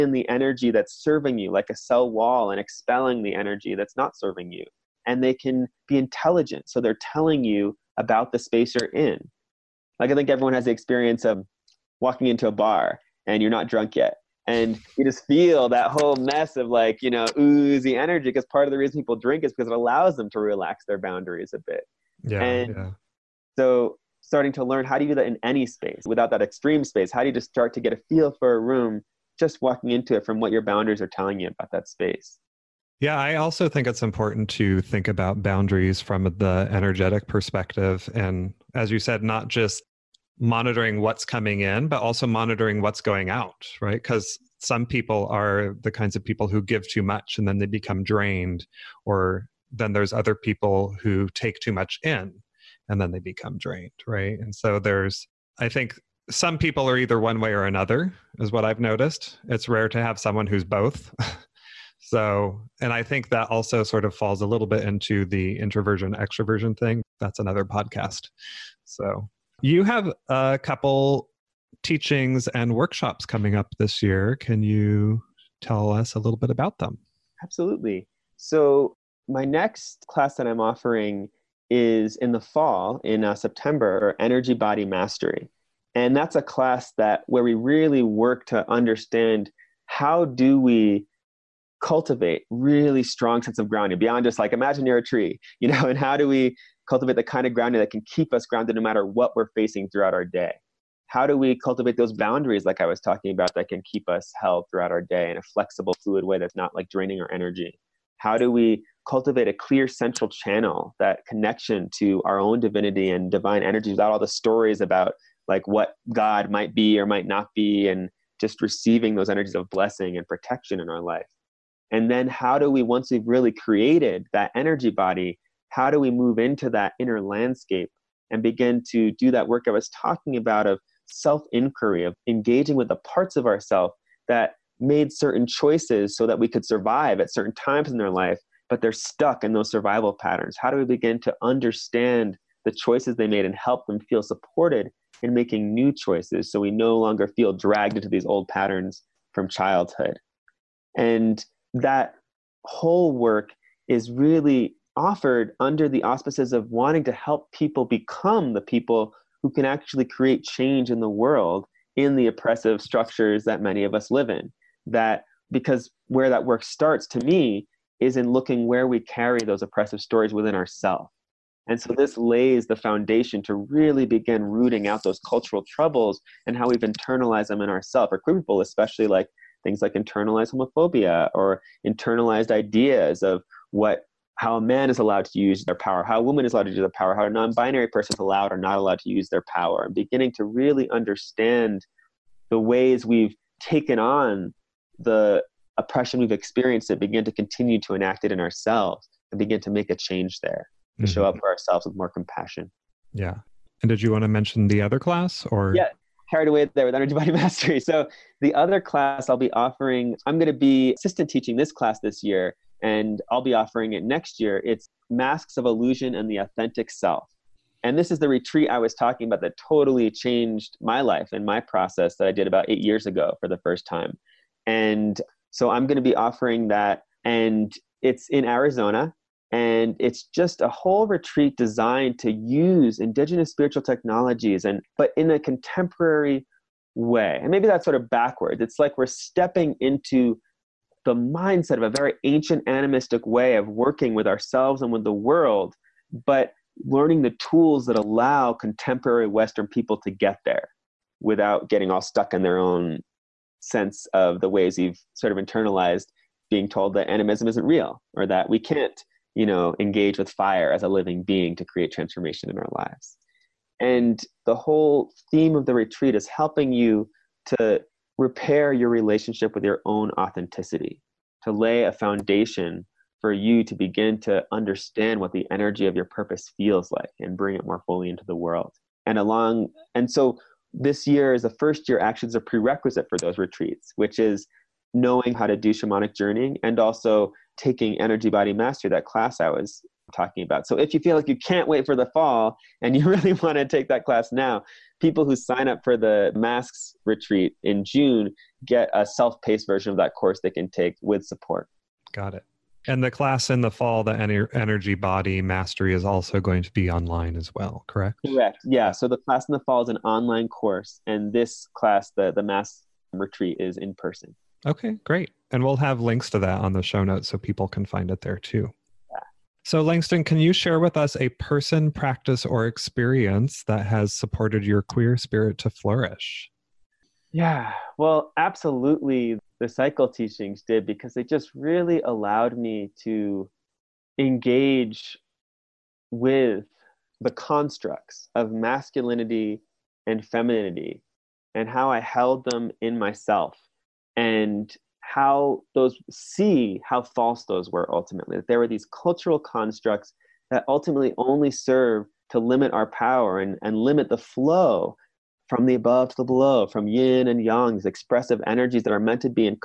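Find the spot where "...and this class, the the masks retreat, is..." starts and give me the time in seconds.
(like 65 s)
311 s.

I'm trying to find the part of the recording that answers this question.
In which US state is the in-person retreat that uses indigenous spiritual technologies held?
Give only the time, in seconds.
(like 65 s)
228 s.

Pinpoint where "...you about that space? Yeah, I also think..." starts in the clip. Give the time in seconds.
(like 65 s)
31 s.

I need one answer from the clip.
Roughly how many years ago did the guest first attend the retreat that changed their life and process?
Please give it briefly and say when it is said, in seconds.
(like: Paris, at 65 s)
8, at 222 s.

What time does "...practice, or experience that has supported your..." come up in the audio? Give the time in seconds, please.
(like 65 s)
321 s.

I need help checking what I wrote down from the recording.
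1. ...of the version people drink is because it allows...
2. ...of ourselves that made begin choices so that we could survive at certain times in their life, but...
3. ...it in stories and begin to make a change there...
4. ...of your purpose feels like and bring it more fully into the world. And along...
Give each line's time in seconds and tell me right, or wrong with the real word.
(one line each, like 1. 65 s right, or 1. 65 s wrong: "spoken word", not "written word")
1. 18 s wrong: "reason", not "version"
2. 133 s wrong: "certain", not "begin"
3. 198 s wrong: "ourselves", not "stories"
4. 275 s right.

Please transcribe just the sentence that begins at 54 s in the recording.
And so there's, I think some people are either one way or another, is what I've noticed.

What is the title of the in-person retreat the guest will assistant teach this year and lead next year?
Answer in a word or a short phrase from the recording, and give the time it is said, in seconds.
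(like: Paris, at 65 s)
Masks of Illusion and the Authentic Self, at 215 s.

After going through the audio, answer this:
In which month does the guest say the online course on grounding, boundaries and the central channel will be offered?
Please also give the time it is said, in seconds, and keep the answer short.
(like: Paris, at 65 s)
September, at 83 s.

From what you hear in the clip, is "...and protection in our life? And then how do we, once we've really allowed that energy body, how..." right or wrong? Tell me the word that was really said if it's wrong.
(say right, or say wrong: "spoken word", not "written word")
wrong: "created", not "allowed".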